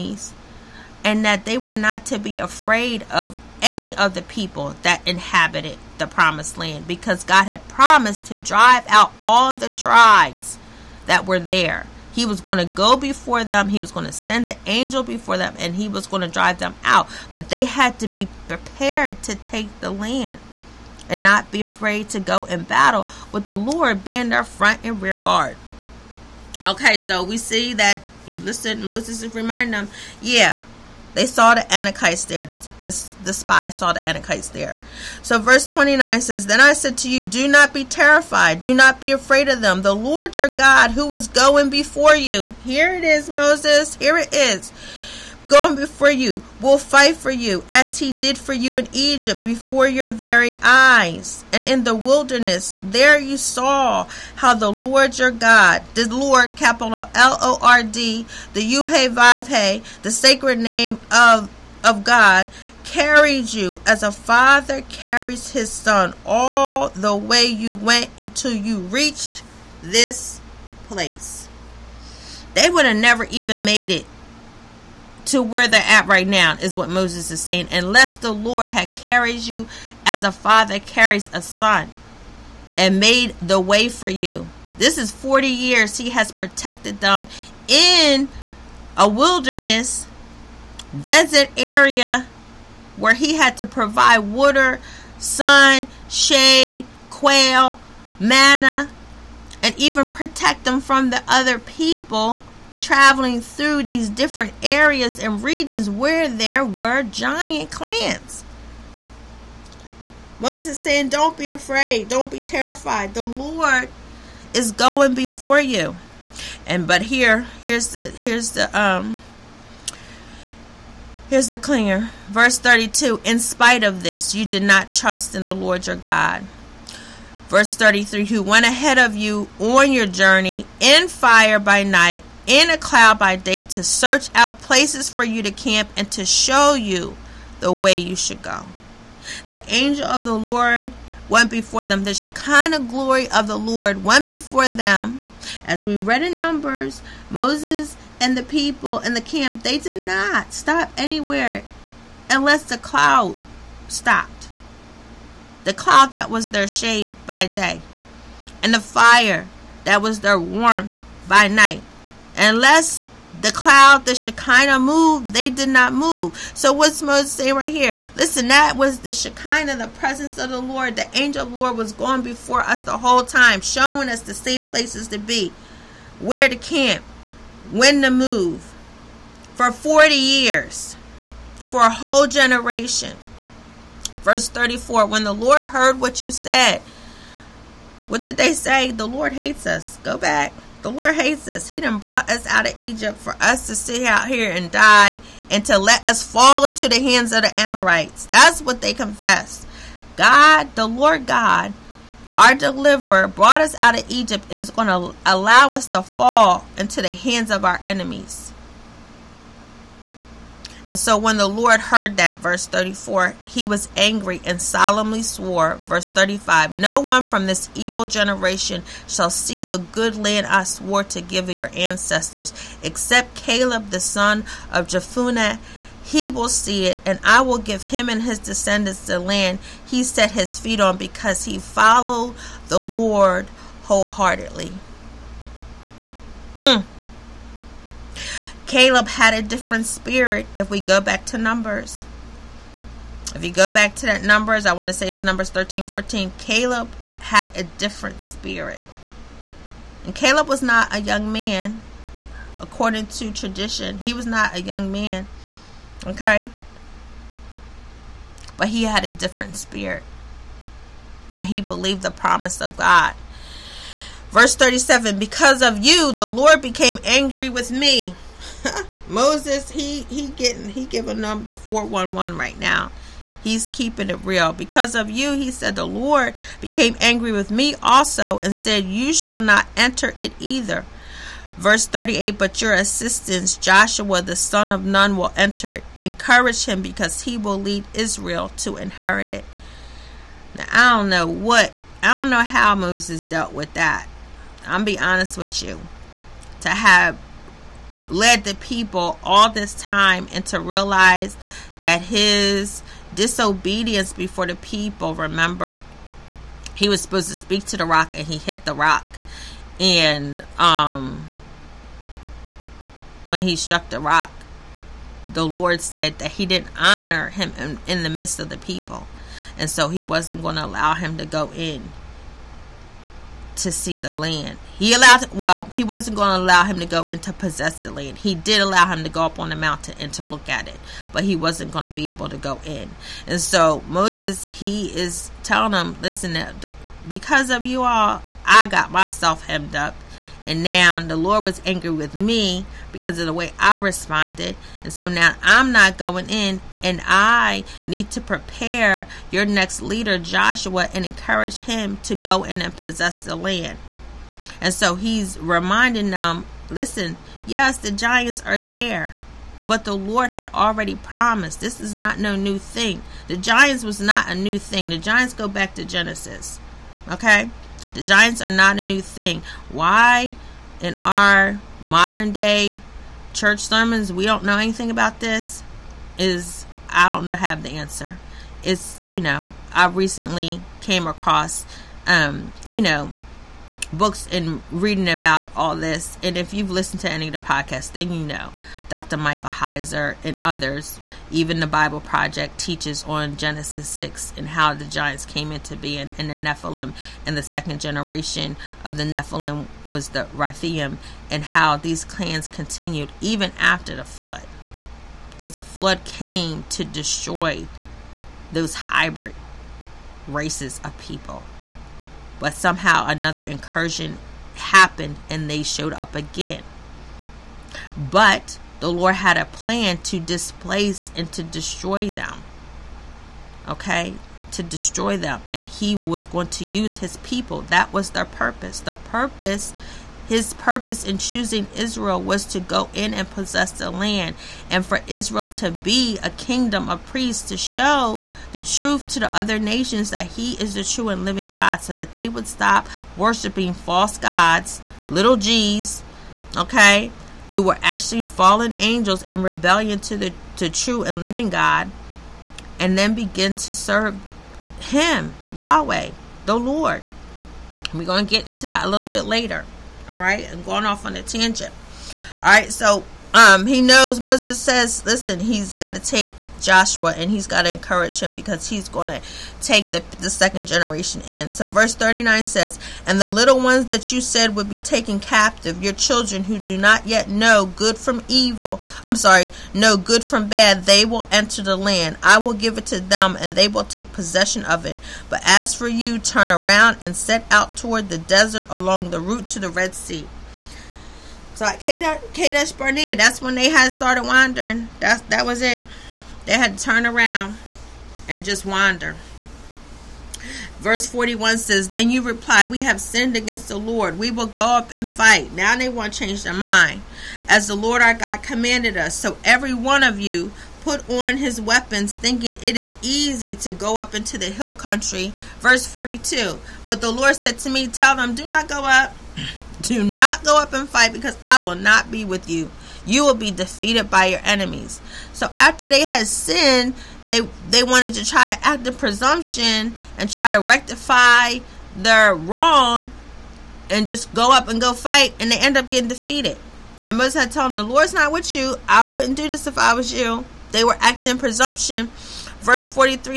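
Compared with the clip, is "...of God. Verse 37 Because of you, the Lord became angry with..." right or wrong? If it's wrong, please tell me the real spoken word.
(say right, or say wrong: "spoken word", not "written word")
right.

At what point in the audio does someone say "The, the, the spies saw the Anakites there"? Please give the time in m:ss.
0:32.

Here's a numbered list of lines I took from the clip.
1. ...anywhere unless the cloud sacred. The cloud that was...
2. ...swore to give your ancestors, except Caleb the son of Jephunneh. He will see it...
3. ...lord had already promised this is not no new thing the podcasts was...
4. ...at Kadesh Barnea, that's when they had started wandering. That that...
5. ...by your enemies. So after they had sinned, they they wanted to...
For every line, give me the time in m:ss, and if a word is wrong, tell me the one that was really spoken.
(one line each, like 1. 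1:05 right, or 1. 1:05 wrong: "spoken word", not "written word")
1. 2:30 wrong: "stopped", not "sacred"
2. 3:40 right
3. 5:59 wrong: "giants", not "podcasts"
4. 8:11 right
5. 8:44 right.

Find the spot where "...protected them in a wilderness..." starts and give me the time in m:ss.
1:26.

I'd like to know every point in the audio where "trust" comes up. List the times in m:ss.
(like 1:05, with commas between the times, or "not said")
2:04.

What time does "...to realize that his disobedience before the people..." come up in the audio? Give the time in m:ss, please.
5:00.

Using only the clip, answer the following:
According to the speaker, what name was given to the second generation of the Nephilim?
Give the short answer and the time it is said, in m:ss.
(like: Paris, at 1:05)
Rephaim, at 6:40.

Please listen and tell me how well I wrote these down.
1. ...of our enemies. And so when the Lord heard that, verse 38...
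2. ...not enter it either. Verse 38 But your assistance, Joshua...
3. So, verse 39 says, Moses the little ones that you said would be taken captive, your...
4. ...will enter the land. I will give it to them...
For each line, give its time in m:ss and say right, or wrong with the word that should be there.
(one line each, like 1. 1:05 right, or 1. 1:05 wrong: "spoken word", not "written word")
1. 3:27 wrong: "34", not "38"
2. 4:39 right
3. 7:51 wrong: "And", not "Moses"
4. 8:01 right.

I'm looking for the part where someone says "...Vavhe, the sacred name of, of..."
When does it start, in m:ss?
0:59.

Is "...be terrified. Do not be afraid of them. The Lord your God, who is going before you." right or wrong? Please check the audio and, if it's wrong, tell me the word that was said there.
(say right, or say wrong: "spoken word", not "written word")
right.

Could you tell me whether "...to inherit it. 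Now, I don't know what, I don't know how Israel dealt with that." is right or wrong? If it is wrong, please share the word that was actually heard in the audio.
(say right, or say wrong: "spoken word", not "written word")
wrong: "Moses", not "Israel".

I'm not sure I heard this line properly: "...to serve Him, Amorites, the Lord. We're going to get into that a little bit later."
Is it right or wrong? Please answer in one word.
wrong.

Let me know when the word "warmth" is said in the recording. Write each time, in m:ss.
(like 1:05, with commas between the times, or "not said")
2:40.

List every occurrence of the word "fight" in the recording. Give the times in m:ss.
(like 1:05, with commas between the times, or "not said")
0:46, 8:25, 8:40, 8:54.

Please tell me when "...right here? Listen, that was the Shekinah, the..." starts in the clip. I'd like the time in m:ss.
2:47.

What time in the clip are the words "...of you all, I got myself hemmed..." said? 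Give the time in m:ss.
5:37.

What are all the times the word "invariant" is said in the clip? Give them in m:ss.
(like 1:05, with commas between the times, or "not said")
not said.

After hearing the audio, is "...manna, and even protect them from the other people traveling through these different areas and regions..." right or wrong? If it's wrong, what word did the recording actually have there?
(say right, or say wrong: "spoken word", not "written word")
right.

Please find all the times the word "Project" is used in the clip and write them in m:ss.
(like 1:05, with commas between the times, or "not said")
6:31.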